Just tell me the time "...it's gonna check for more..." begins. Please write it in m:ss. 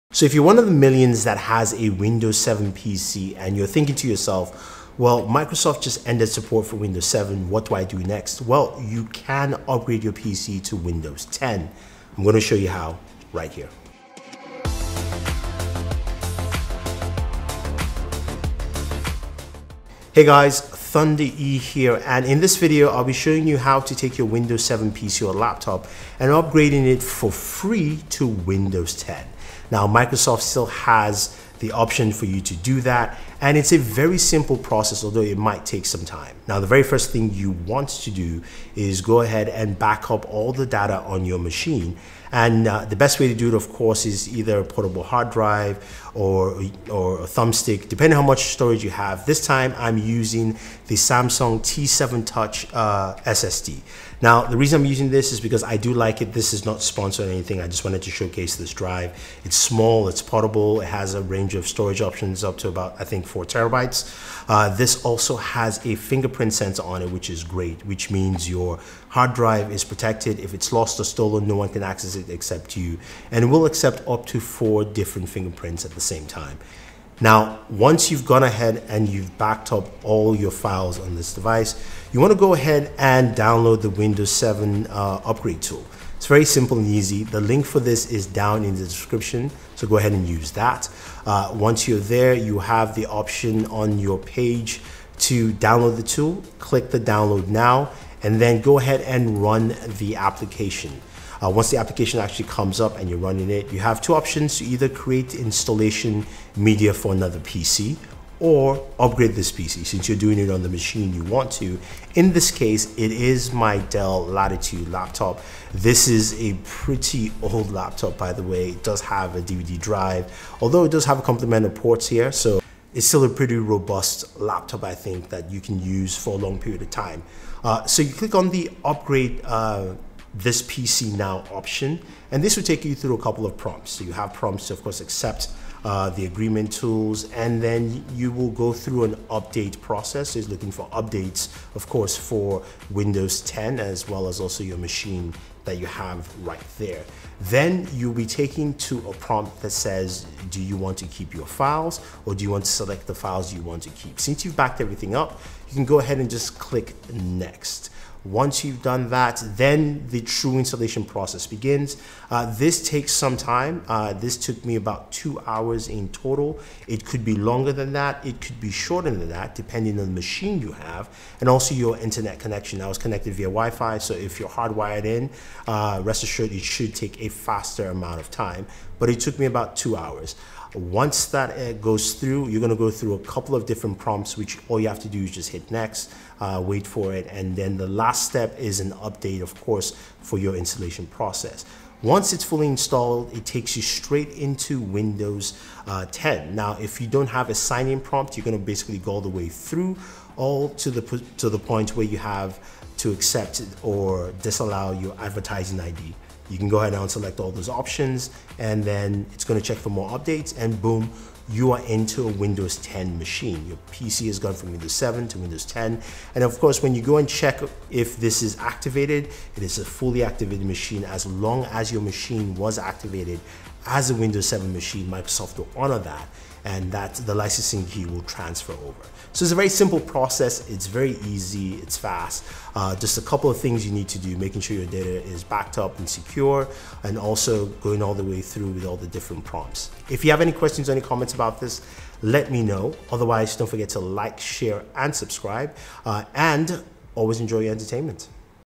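3:29.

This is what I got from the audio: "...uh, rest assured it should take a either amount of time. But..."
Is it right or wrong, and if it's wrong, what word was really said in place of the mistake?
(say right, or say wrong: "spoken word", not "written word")
wrong: "faster", not "either".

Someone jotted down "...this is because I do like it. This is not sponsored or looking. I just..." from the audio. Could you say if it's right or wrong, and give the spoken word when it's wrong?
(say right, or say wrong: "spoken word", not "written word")
wrong: "anything", not "looking".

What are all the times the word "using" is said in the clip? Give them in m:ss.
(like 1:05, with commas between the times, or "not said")
0:49, 0:54.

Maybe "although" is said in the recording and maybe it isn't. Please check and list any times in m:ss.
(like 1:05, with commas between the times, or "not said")
0:35, 2:00.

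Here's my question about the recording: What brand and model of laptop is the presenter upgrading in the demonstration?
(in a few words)
Dell Latitude.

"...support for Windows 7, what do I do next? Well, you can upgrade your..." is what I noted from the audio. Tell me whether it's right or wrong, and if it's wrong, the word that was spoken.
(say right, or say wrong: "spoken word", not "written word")
right.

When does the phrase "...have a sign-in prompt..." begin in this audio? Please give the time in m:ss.
3:17.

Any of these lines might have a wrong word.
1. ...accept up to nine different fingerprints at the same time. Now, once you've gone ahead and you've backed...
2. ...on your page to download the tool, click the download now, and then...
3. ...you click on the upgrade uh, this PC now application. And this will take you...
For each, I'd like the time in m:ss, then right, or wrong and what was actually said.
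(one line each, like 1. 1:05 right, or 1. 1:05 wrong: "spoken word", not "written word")
1. 1:13 wrong: "four", not "nine"
2. 1:33 right
3. 2:08 wrong: "option", not "application".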